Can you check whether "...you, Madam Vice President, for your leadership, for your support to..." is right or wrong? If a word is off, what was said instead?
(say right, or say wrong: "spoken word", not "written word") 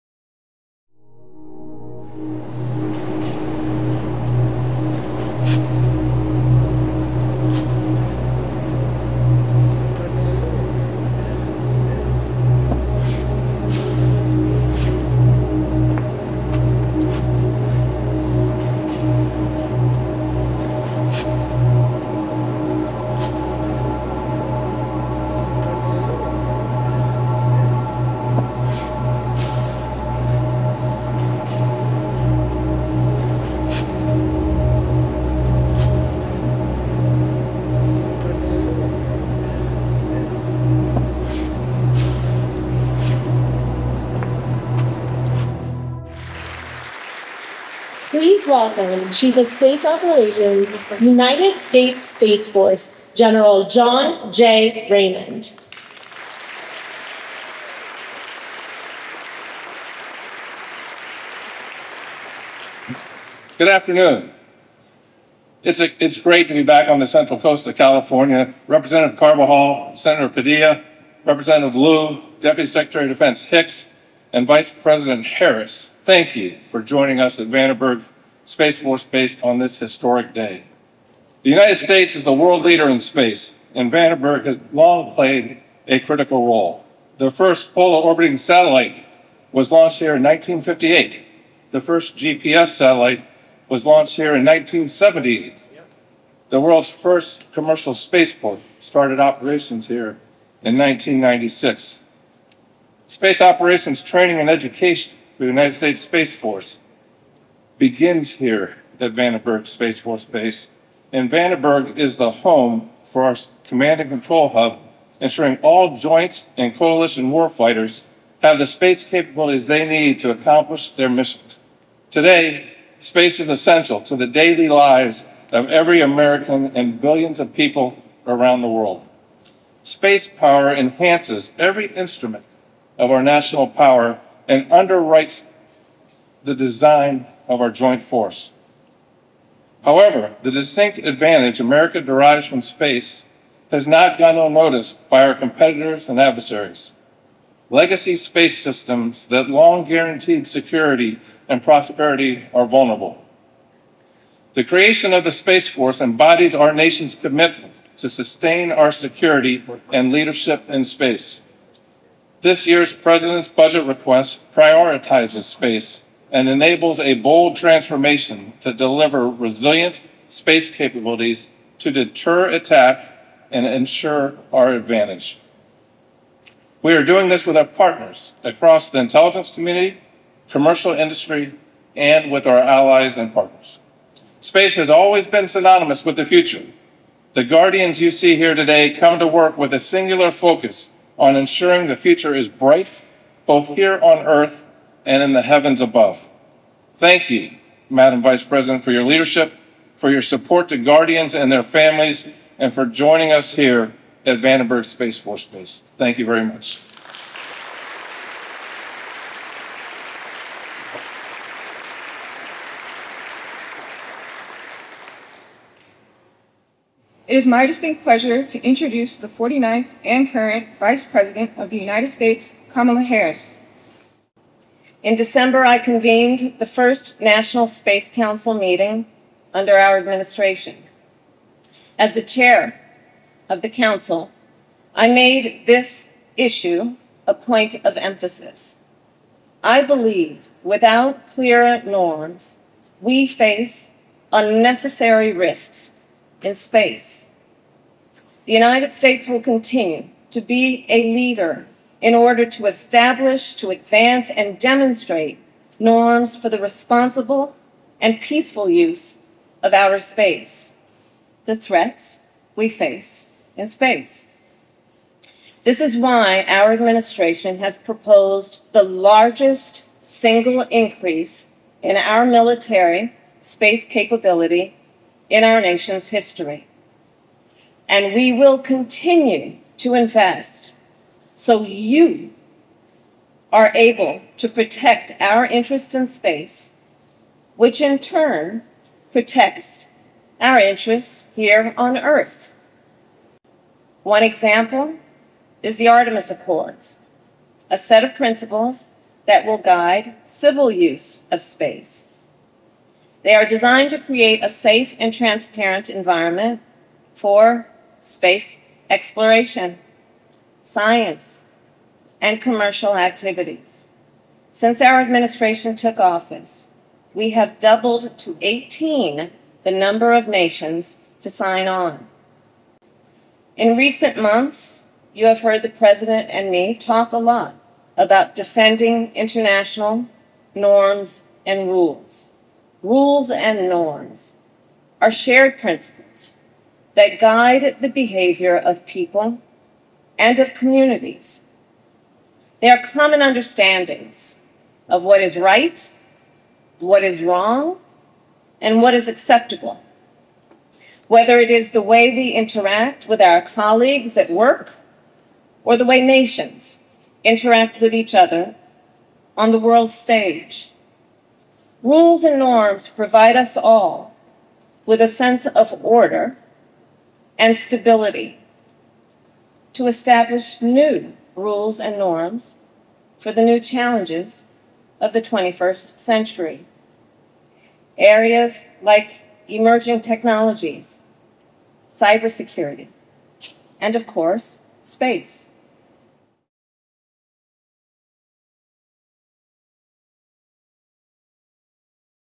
right.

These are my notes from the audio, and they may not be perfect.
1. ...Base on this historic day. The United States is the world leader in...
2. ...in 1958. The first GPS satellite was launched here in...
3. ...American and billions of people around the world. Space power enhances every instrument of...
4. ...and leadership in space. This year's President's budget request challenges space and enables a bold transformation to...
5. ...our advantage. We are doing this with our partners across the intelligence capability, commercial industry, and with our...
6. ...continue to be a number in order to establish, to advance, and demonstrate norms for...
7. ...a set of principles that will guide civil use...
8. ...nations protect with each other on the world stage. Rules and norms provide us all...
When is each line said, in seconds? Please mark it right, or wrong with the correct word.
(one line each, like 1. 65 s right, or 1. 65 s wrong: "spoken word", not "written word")
1. 79 s right
2. 90 s right
3. 126 s right
4. 159 s wrong: "prioritizes", not "challenges"
5. 174 s wrong: "community", not "capability"
6. 249 s wrong: "leader", not "number"
7. 297 s right
8. 356 s wrong: "interact", not "protect".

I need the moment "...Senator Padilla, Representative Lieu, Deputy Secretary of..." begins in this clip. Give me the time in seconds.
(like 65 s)
69 s.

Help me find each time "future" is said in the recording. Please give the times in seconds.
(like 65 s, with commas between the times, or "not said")
186 s, 191 s.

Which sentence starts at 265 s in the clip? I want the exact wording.
This is why our administration has proposed the largest single increase in our military space capability in our nation's history.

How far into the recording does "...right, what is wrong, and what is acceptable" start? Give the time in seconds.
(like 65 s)
345 s.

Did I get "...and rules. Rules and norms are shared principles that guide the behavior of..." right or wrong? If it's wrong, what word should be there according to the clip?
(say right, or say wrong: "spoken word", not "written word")
right.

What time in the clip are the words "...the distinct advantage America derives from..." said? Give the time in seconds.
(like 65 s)
140 s.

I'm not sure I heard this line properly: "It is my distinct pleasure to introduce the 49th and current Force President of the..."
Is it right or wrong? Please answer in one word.
wrong.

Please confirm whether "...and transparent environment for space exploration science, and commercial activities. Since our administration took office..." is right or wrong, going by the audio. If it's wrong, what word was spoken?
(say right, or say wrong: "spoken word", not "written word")
right.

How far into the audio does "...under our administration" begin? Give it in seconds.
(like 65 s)
229 s.